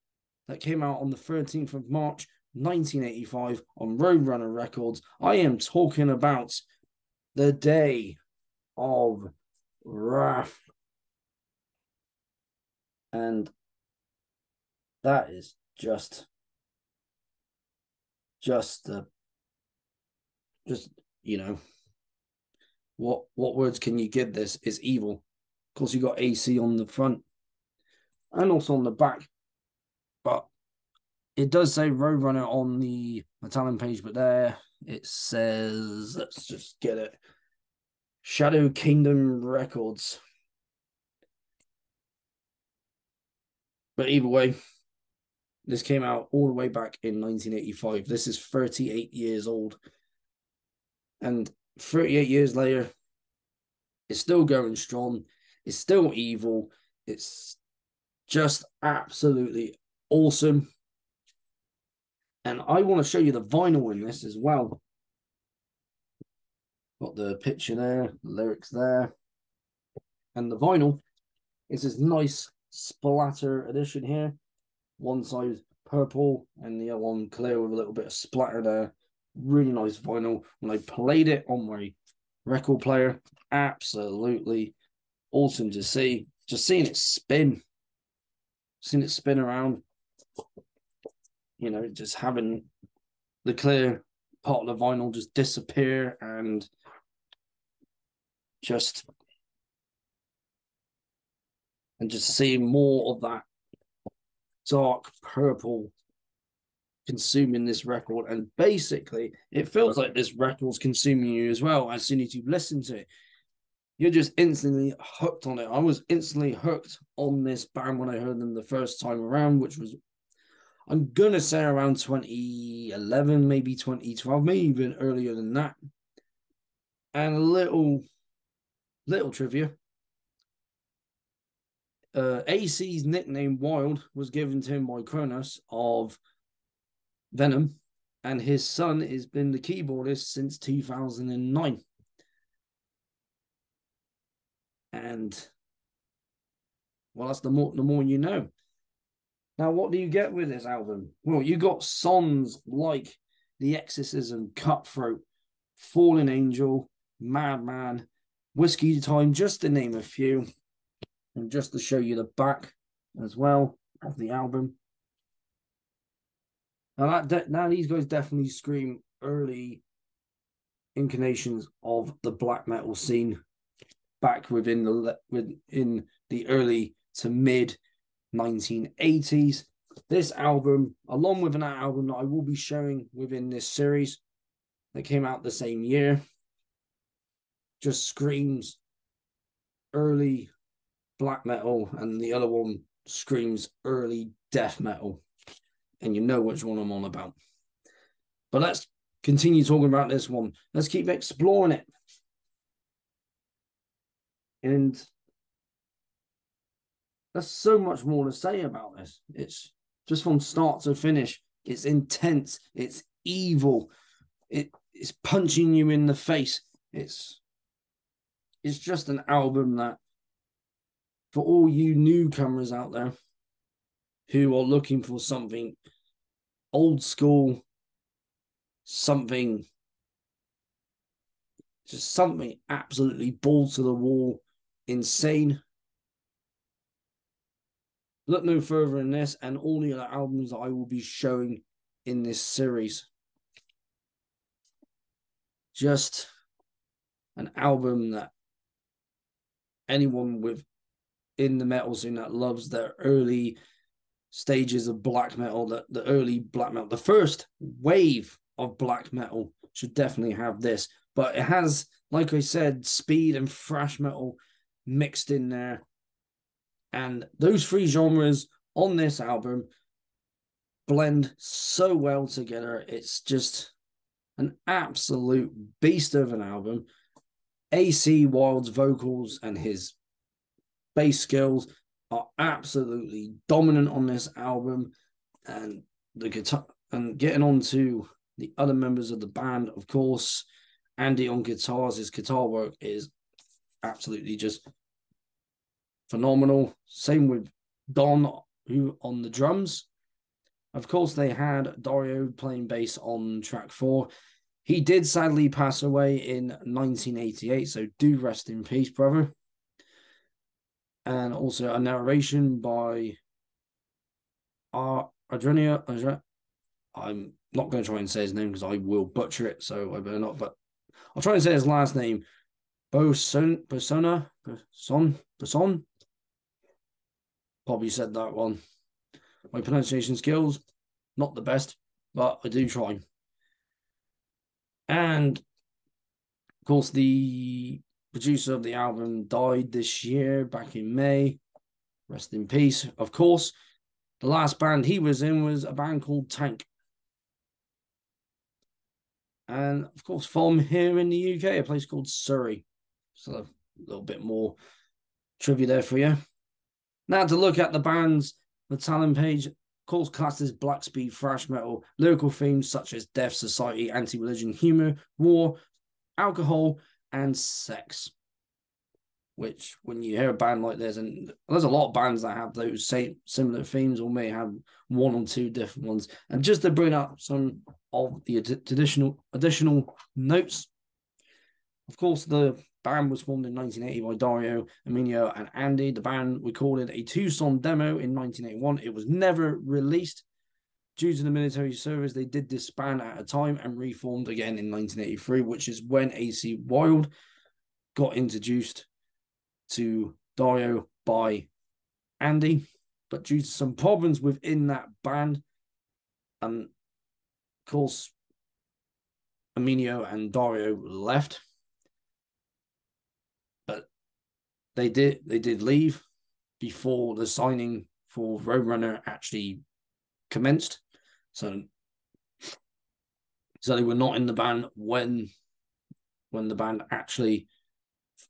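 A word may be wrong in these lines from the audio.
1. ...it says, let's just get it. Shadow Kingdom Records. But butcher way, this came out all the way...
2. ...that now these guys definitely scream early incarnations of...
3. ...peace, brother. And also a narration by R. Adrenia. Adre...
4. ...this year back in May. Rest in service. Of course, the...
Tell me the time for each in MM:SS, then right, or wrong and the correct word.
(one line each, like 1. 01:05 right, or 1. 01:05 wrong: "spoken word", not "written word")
1. 00:34 wrong: "either", not "butcher"
2. 02:47 right
3. 05:08 right
4. 05:39 wrong: "peace", not "service".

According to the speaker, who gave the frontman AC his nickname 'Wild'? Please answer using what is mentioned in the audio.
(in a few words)
Cronos.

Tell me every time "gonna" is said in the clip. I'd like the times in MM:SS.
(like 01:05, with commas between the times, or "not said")
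02:01.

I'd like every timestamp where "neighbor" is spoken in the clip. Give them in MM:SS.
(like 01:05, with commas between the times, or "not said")
not said.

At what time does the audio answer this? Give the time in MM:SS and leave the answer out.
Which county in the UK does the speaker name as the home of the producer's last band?
05:52.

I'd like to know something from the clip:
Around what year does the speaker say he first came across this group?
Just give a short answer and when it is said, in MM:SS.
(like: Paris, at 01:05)
2011, at 02:01.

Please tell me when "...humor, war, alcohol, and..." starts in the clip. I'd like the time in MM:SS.
06:04.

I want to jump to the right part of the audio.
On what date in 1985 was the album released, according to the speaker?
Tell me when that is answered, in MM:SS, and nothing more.
00:01.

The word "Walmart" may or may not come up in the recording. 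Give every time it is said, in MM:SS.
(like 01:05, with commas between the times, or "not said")
not said.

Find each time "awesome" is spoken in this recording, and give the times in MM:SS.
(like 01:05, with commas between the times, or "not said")
01:00, 01:25.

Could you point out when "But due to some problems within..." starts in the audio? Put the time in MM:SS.
06:43.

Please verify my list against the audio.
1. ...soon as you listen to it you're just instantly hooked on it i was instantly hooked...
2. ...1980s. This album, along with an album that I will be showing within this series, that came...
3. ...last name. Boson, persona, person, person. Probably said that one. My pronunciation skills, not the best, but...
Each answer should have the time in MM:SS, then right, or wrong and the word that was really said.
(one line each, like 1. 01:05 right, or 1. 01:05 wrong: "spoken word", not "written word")
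1. 01:52 right
2. 02:58 right
3. 05:21 right.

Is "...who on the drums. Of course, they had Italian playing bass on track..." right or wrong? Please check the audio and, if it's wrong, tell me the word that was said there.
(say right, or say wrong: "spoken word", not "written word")
wrong: "Dario", not "Italian".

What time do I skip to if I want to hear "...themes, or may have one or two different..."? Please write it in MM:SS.
06:13.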